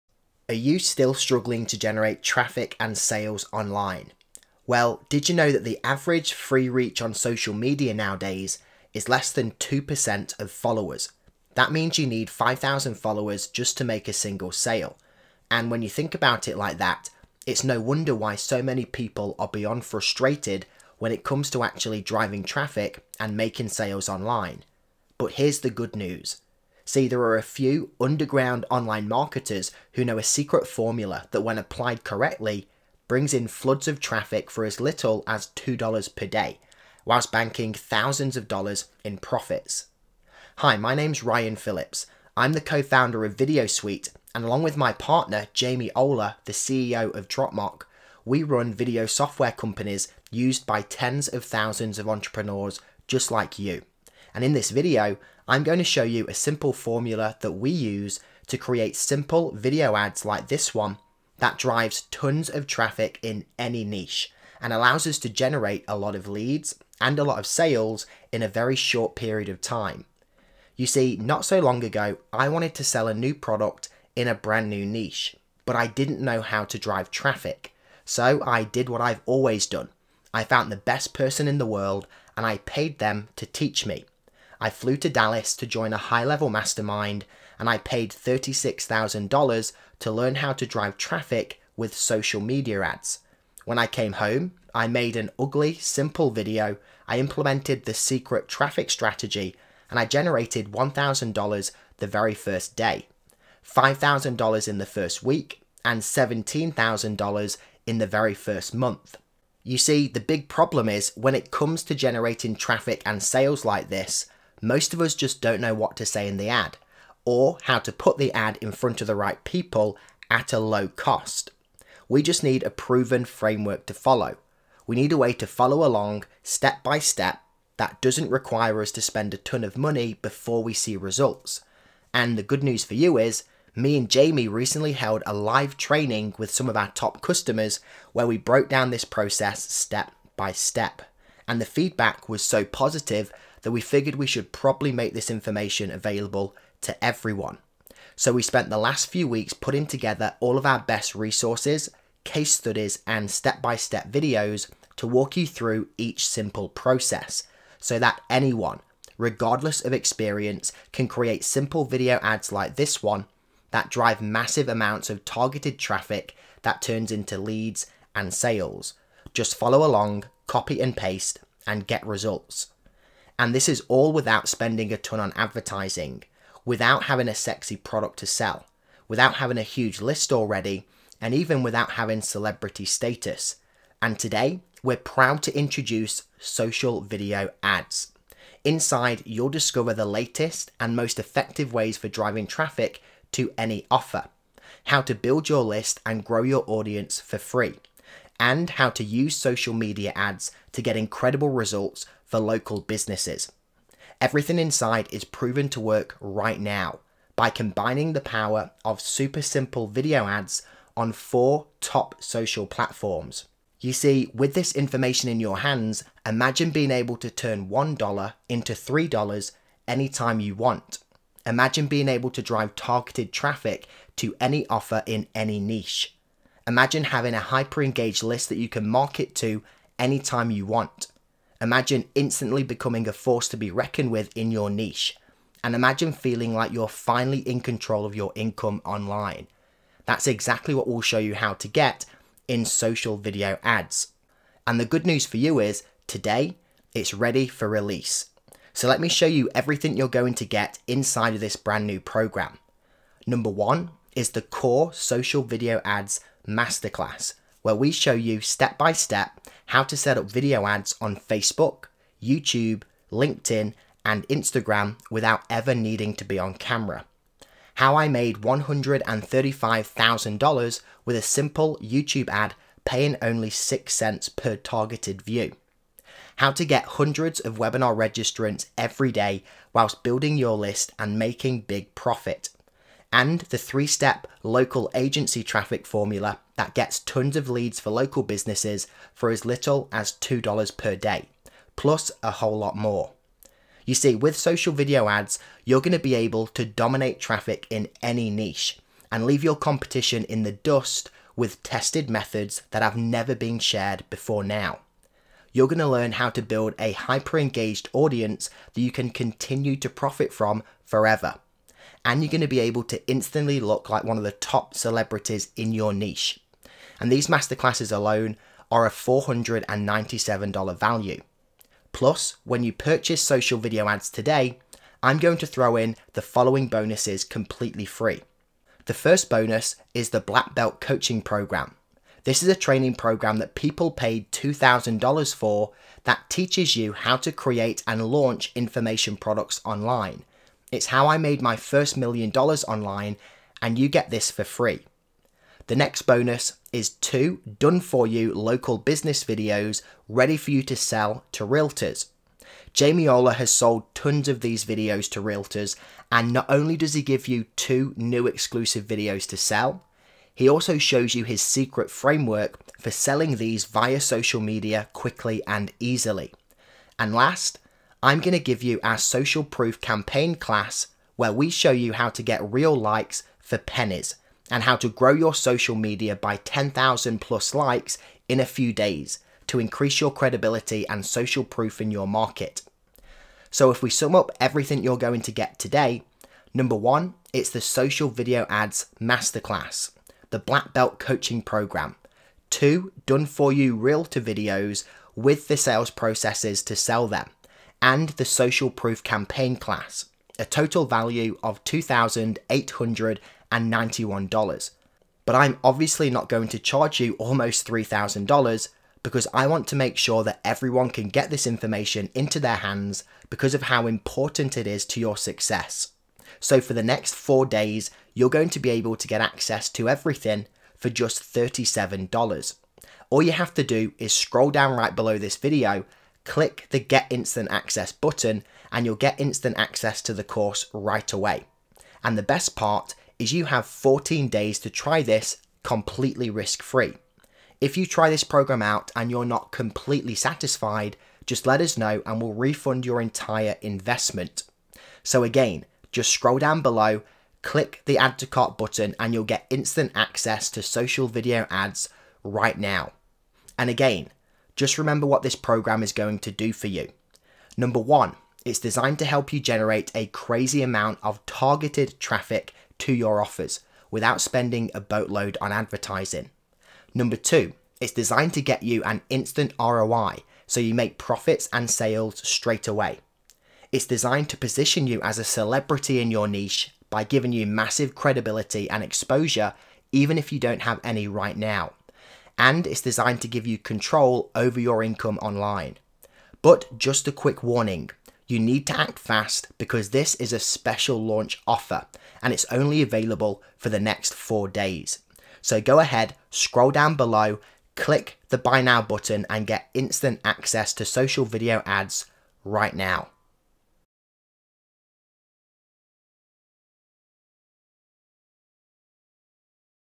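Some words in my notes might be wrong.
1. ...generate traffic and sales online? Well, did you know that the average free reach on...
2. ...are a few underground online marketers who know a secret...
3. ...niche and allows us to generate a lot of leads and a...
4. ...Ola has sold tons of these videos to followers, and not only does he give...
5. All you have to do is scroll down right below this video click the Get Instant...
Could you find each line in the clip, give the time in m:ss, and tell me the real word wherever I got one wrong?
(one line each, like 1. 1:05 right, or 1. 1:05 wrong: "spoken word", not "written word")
1. 0:01 right
2. 0:27 right
3. 1:03 right
4. 5:53 wrong: "realtors", not "followers"
5. 7:03 right.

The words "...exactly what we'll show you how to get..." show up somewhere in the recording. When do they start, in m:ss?
4:00.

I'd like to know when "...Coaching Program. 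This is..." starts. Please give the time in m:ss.
5:30.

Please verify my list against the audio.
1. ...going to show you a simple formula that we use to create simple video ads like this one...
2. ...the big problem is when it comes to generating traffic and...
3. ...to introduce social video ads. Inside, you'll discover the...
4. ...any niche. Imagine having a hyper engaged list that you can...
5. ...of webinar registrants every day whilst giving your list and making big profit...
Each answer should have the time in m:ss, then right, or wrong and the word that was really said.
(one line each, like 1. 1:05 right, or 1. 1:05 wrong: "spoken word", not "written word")
1. 0:55 right
2. 1:50 right
3. 3:05 right
4. 3:45 right
5. 4:37 wrong: "building", not "giving".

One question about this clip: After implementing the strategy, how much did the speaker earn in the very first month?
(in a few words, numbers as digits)
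$17,000.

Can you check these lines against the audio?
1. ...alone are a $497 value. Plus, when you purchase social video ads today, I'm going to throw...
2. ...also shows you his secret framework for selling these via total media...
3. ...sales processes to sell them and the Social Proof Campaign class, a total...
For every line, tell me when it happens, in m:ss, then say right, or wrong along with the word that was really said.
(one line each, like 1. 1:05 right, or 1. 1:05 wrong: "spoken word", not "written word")
1. 5:17 right
2. 6:00 wrong: "social", not "total"
3. 6:35 right.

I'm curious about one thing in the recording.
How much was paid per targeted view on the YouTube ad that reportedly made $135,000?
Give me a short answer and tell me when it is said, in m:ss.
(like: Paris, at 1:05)
6 cents, at 4:33.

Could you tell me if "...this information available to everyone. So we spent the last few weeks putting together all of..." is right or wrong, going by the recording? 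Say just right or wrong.
right.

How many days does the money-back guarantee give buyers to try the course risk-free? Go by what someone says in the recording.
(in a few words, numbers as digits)
14.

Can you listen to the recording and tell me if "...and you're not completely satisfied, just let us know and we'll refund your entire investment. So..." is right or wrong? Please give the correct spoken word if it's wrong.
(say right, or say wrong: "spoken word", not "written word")
right.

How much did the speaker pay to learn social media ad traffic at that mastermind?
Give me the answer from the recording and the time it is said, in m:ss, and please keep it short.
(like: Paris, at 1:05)
$36,000, at 1:28.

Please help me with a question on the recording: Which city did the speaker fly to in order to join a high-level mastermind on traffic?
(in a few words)
Dallas.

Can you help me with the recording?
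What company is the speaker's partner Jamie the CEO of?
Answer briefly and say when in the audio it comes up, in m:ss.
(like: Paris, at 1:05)
Dropmark, at 0:47.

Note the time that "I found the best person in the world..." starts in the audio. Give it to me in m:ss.
1:20.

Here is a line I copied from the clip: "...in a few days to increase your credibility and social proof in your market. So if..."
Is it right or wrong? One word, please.
right.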